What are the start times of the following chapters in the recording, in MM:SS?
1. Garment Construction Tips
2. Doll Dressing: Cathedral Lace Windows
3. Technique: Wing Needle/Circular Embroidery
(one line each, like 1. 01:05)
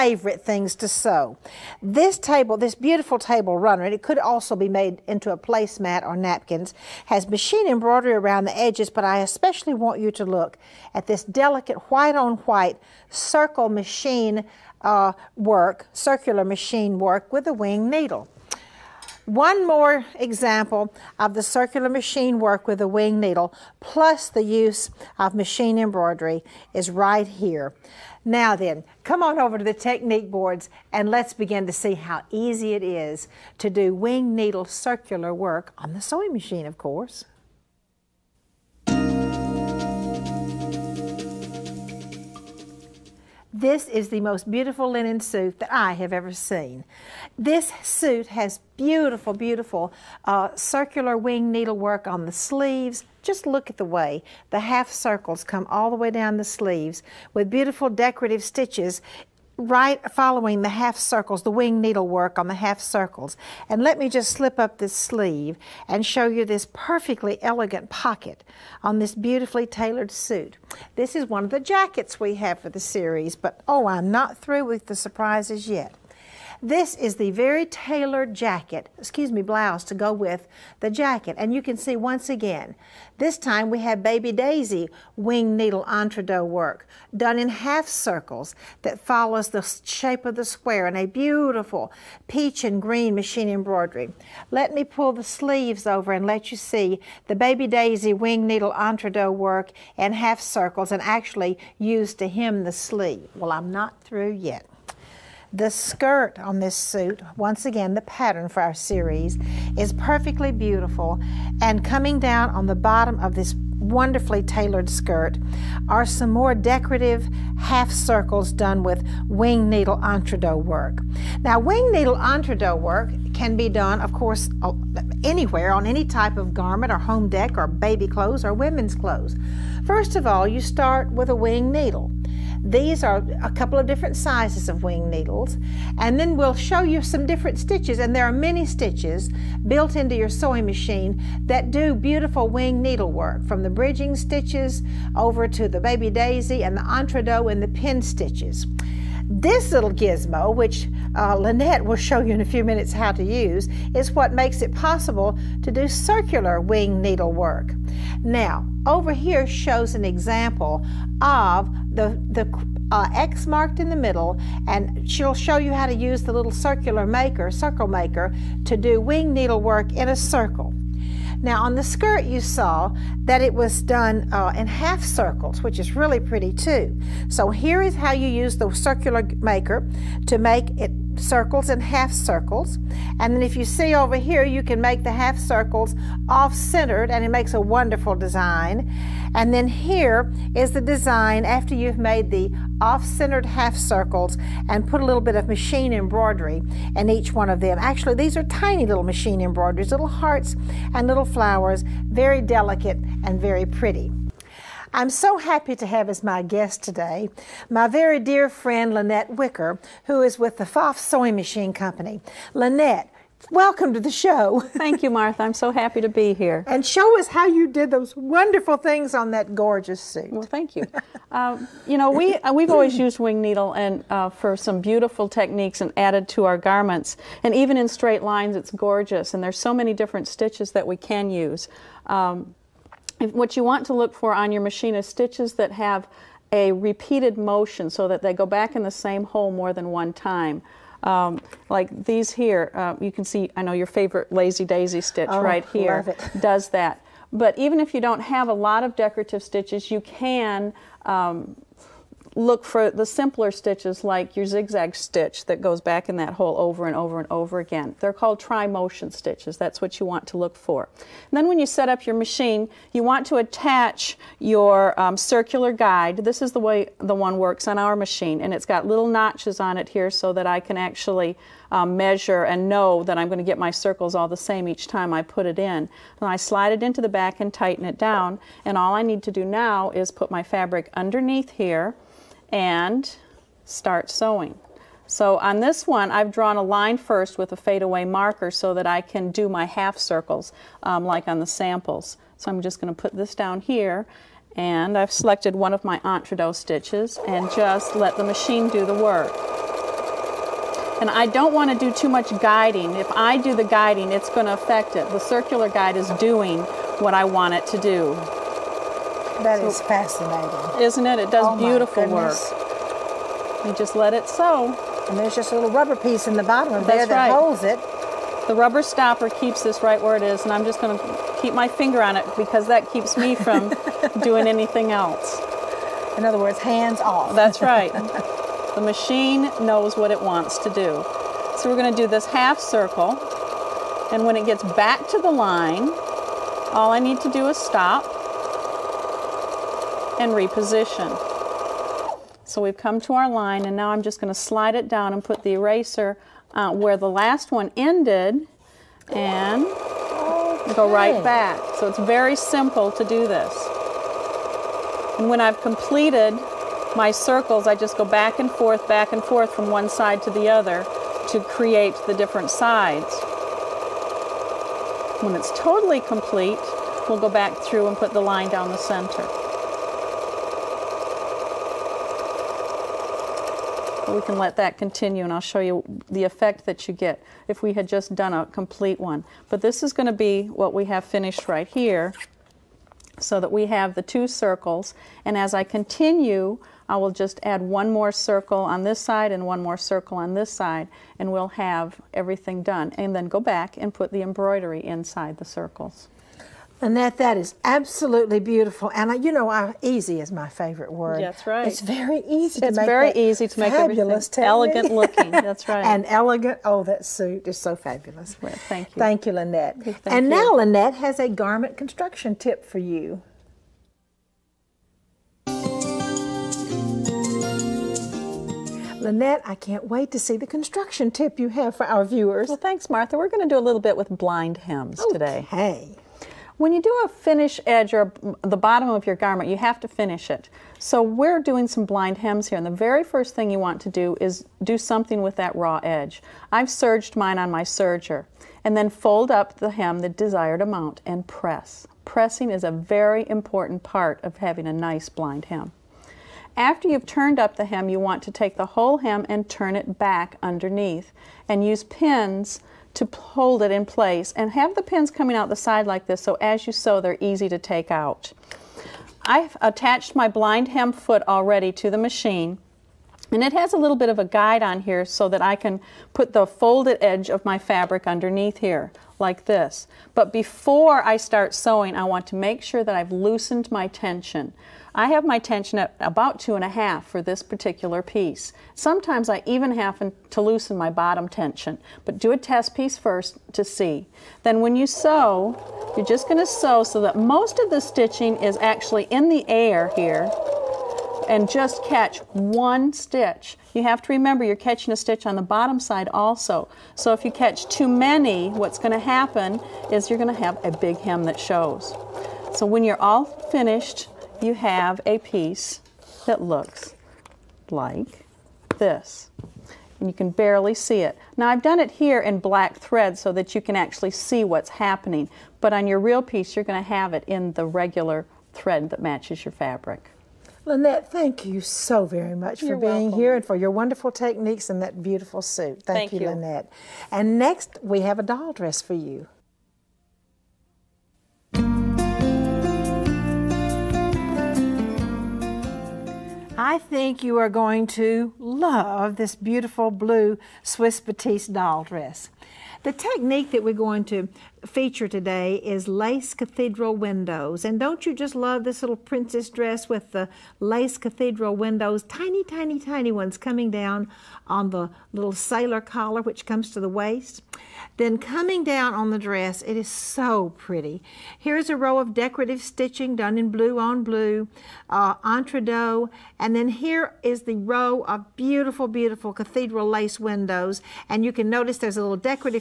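1. 06:55
2. 08:52
3. 00:39.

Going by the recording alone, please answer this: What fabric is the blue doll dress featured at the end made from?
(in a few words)
Swiss Batiste.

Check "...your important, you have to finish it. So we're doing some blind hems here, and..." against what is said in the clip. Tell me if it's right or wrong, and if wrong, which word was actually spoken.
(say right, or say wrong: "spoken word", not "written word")
wrong: "garment", not "important".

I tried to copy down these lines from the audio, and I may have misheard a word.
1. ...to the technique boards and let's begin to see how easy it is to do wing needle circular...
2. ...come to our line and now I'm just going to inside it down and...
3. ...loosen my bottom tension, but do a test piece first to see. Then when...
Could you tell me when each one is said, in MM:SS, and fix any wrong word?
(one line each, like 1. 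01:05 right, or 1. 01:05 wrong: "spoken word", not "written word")
1. 00:29 right
2. 05:42 wrong: "slide", not "inside"
3. 08:00 right.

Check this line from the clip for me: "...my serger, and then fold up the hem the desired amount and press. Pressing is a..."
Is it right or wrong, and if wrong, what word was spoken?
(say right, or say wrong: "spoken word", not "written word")
right.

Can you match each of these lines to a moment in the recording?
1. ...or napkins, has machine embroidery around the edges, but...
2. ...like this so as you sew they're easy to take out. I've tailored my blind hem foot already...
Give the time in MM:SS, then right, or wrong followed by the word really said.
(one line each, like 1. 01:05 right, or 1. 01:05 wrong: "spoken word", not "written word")
1. 00:06 right
2. 07:35 wrong: "attached", not "tailored".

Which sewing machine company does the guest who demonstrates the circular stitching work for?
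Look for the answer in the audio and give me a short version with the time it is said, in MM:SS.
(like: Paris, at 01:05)
Foff Sewing Machine Company, at 03:30.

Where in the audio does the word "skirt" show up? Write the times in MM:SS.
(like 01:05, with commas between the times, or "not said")
01:45, 01:54, 02:51.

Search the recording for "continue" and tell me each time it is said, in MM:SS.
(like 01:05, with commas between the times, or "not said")
06:14, 06:25.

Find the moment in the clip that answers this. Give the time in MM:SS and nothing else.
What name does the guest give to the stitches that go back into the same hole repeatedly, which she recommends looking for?
04:18.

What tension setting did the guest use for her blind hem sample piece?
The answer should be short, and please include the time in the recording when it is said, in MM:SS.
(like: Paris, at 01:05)
2.5, at 07:56.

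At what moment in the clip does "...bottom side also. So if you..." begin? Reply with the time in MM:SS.
08:15.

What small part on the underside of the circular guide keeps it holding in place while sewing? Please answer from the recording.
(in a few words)
rubber stopper.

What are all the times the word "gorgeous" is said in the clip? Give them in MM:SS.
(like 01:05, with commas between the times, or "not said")
03:39, 03:48.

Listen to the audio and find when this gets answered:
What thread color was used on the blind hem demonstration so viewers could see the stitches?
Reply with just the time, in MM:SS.
08:32.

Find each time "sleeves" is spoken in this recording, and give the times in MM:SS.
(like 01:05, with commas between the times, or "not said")
00:52, 00:56, 01:04, 01:35, 01:42.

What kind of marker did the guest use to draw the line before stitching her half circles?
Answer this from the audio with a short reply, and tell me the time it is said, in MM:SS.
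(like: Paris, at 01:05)
fadeaway marker, at 04:47.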